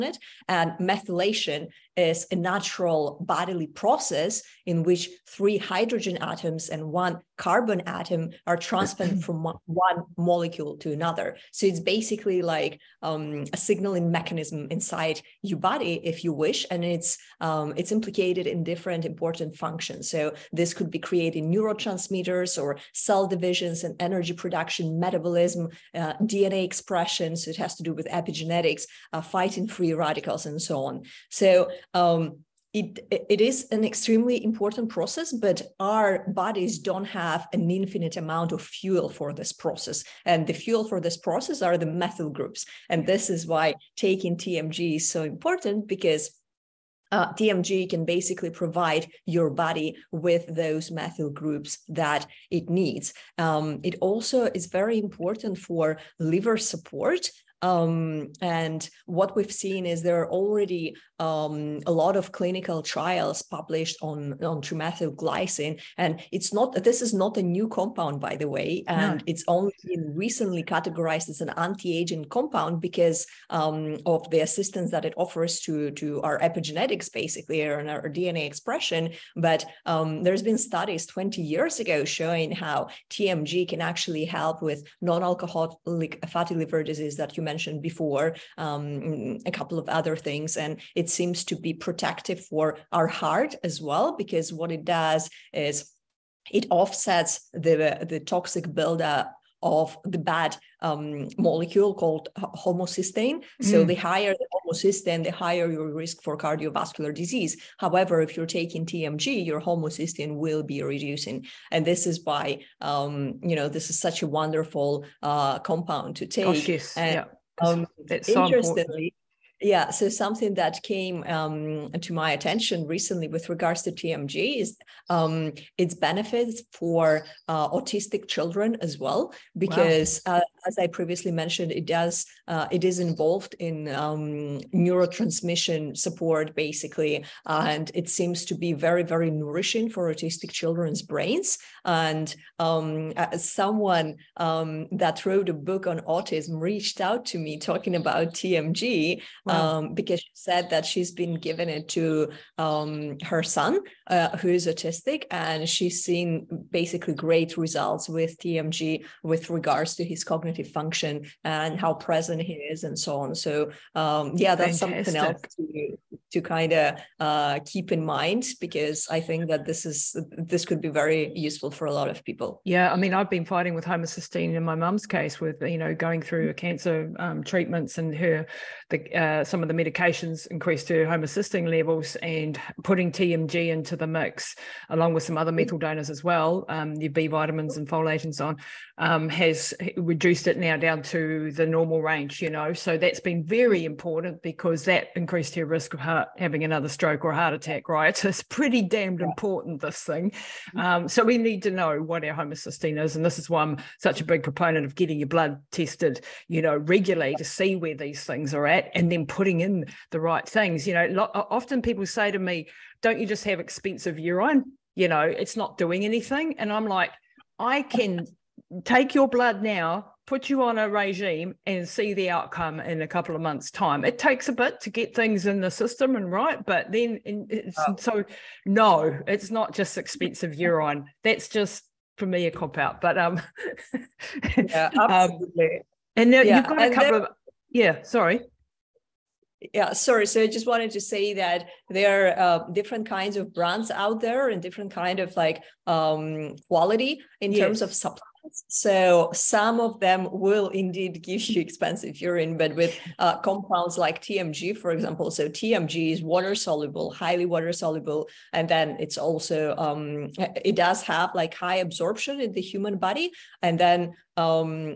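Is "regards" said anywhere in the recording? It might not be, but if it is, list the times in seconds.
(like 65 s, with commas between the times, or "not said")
123 s, 159 s.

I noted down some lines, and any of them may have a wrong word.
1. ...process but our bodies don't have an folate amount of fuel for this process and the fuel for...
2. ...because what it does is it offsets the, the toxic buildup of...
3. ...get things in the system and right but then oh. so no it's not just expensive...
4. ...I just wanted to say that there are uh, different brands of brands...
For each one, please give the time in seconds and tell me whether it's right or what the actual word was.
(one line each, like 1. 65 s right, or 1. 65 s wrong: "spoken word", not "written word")
1. 34 s wrong: "infinite", not "folate"
2. 94 s right
3. 224 s right
4. 240 s wrong: "kinds", not "brands".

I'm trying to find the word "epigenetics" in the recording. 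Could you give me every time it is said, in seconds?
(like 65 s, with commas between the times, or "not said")
28 s, 76 s.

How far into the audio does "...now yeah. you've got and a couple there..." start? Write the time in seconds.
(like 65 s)
236 s.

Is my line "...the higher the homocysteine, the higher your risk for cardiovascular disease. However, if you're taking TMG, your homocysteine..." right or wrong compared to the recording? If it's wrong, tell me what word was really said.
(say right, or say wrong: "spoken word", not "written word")
right.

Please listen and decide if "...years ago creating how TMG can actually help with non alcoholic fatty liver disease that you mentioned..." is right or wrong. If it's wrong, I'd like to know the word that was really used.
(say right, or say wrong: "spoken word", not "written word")
wrong: "showing", not "creating".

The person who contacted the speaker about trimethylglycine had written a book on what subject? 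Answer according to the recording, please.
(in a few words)
autism.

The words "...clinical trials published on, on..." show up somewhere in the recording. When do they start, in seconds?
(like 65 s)
62 s.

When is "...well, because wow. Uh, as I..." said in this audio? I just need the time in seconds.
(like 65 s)
128 s.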